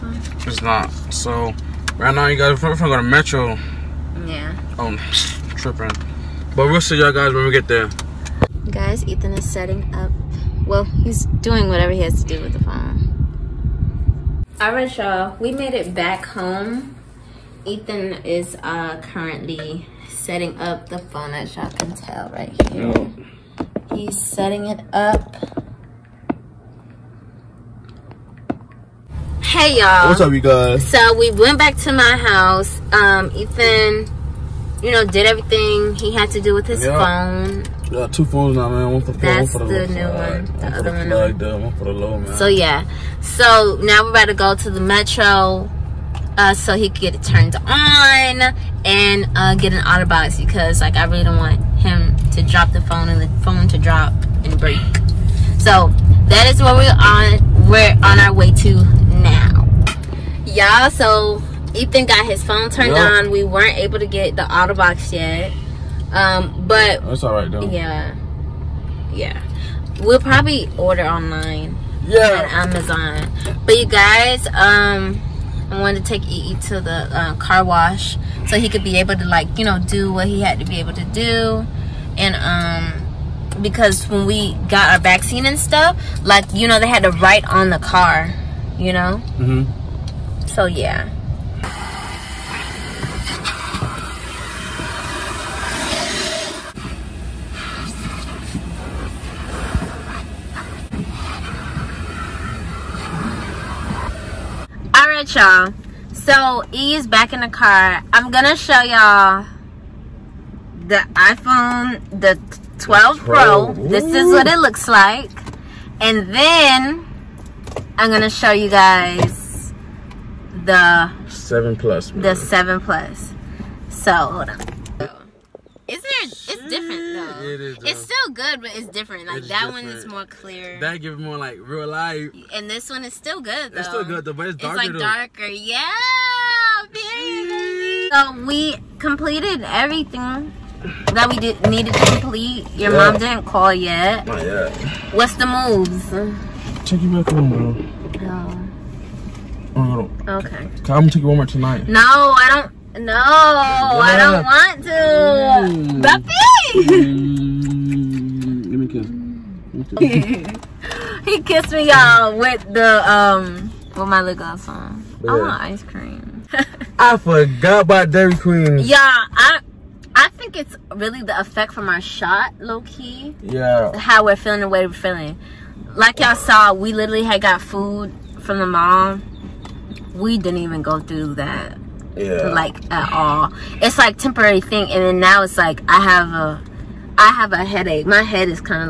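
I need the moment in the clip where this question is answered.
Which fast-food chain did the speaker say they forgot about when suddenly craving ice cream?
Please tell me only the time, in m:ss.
2:48.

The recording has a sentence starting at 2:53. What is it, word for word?
How we're feeling the way we're feeling.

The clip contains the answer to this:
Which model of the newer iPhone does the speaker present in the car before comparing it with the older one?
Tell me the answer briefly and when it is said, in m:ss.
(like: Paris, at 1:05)
12 Pro, at 1:52.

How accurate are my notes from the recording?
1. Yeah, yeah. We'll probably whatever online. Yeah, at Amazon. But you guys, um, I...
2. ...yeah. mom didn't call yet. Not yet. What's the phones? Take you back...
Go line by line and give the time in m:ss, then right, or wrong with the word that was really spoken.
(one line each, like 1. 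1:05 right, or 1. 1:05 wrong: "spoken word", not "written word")
1. 1:07 wrong: "order", not "whatever"
2. 2:22 wrong: "moves", not "phones".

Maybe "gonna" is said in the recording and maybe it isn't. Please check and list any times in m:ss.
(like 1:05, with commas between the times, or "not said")
0:02, 1:48, 1:58, 2:30.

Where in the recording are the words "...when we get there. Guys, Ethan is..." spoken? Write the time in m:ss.
0:07.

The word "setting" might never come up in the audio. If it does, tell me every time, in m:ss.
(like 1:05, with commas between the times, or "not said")
0:09, 0:20, 0:24.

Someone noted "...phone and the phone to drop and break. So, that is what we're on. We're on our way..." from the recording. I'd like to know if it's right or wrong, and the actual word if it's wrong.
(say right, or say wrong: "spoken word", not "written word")
right.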